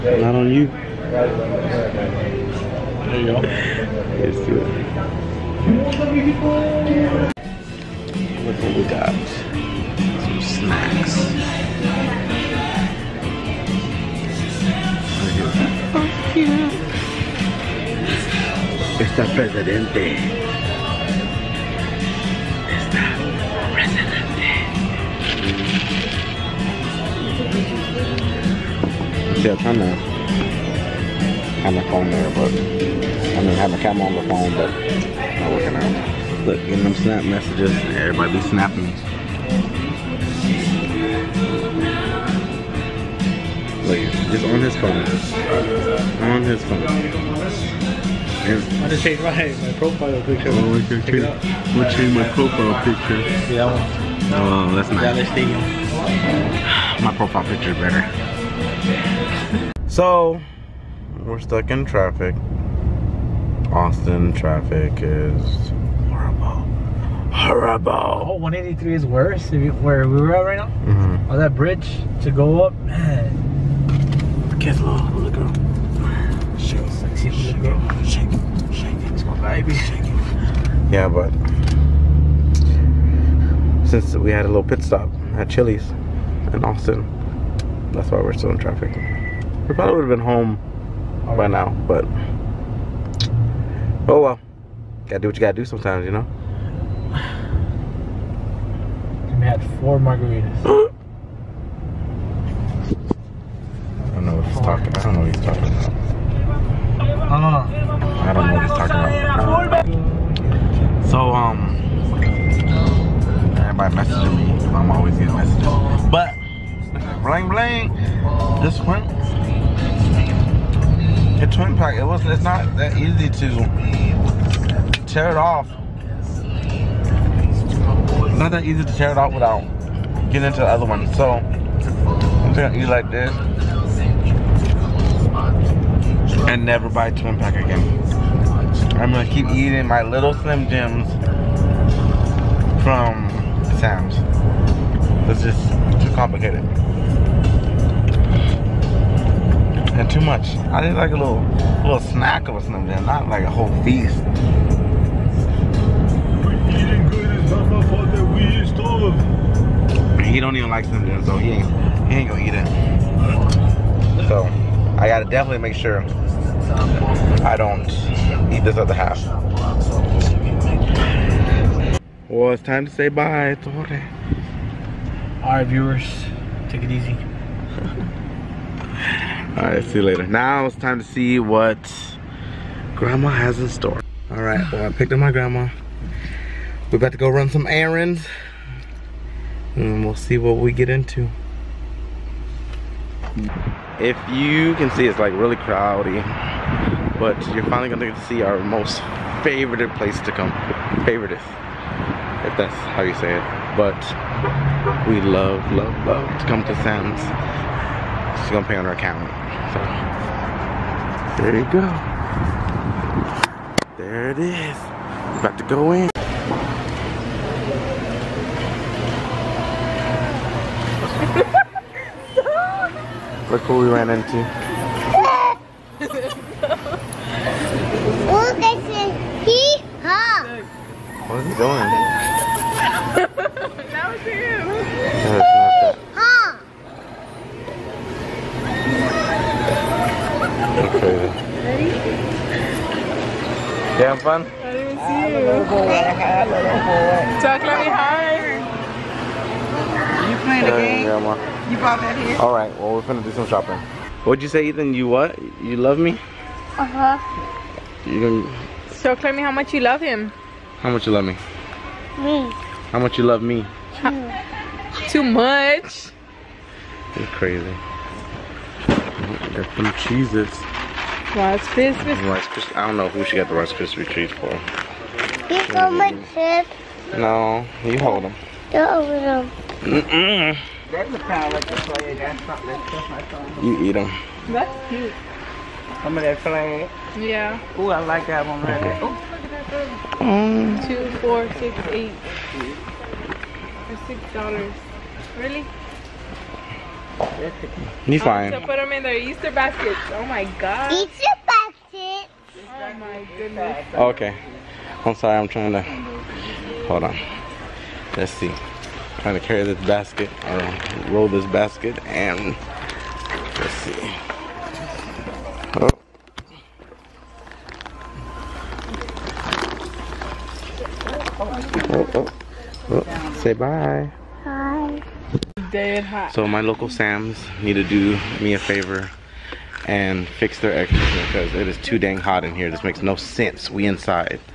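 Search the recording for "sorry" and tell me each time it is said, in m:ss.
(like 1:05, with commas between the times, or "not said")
5:05.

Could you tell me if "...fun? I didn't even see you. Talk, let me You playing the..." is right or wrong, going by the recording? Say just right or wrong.
right.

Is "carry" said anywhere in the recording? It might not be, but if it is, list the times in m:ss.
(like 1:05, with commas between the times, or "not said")
5:09.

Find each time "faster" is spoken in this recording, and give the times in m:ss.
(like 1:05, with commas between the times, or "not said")
not said.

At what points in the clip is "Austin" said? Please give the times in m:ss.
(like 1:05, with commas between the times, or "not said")
1:03, 1:26.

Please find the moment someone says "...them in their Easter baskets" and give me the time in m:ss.
4:58.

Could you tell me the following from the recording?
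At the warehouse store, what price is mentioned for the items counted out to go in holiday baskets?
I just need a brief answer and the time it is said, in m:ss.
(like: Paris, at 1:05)
$6, at 4:54.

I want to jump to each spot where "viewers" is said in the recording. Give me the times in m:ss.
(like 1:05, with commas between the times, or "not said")
2:55.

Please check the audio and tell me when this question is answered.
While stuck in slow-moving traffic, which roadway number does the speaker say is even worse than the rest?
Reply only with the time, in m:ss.
1:08.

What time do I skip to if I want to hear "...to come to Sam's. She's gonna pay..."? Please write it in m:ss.
3:26.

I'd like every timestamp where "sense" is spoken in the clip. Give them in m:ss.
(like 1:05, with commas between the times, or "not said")
5:33.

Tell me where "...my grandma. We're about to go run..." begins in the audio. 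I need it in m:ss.
3:05.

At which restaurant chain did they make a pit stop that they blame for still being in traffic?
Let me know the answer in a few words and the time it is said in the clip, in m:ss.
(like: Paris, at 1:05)
Chili's, at 1:25.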